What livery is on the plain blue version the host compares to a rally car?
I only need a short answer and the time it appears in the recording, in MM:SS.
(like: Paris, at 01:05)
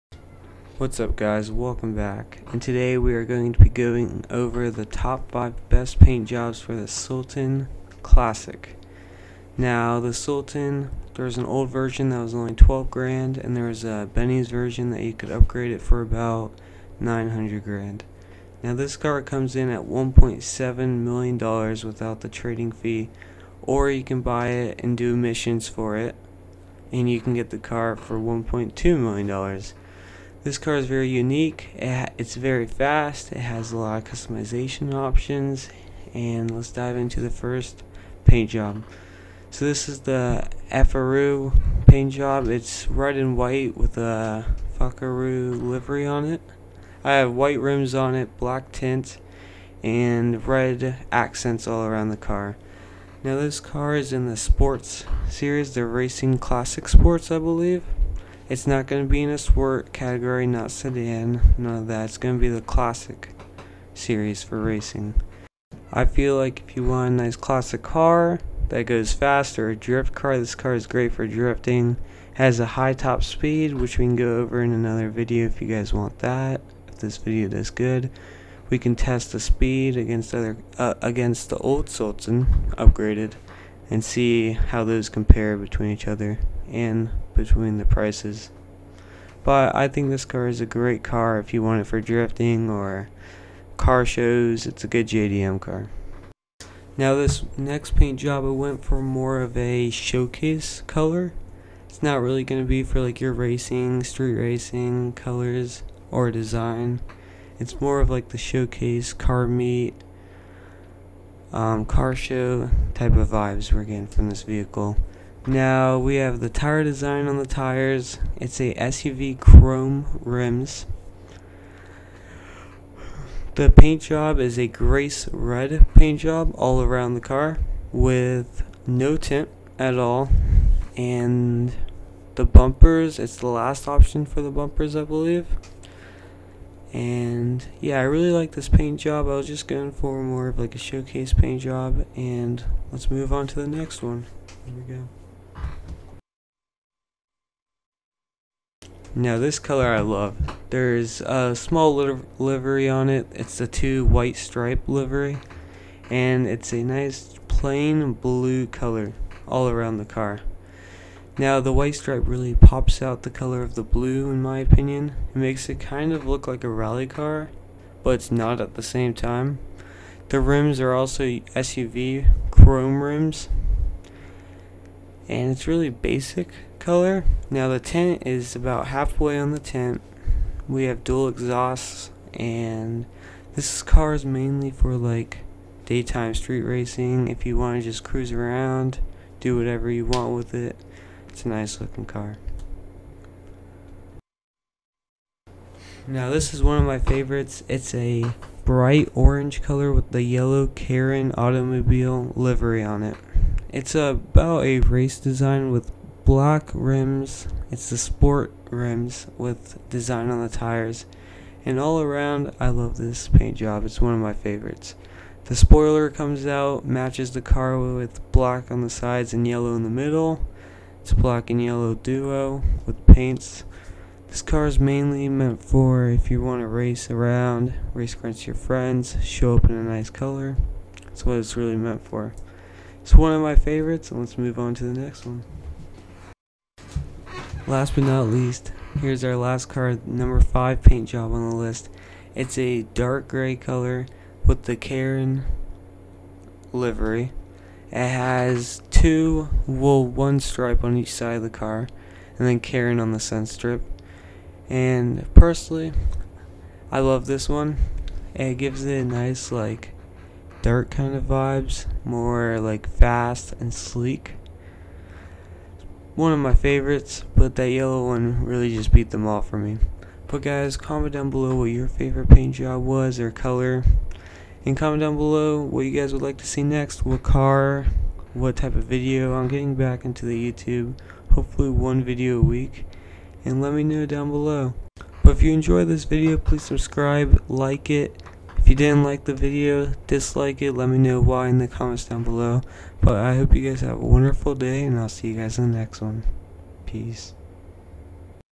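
two white stripe livery, at 02:33.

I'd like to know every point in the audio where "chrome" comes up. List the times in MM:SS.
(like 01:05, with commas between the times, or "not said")
01:59, 02:52.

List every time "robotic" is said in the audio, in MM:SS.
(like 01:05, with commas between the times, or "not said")
not said.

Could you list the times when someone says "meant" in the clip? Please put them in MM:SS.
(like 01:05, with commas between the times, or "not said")
03:45, 03:51.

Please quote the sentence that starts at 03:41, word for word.
It's black and yellow duo with paints.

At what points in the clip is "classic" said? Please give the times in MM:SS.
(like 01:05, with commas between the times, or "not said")
00:08, 00:56, 01:02, 01:07.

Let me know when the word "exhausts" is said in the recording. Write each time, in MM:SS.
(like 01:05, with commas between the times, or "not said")
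03:01.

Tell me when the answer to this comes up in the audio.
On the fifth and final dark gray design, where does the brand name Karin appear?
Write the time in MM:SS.
04:13.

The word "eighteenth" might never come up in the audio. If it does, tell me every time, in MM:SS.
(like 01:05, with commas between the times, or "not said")
not said.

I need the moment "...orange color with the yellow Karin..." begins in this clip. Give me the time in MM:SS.
03:19.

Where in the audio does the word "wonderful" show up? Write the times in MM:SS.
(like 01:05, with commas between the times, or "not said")
04:54.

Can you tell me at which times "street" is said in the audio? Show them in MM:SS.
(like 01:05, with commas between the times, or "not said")
01:44, 03:06.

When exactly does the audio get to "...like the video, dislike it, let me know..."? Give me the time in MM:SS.
04:49.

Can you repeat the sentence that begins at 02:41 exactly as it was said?
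Now the white stripe really pops out the color of the blue in my opinion.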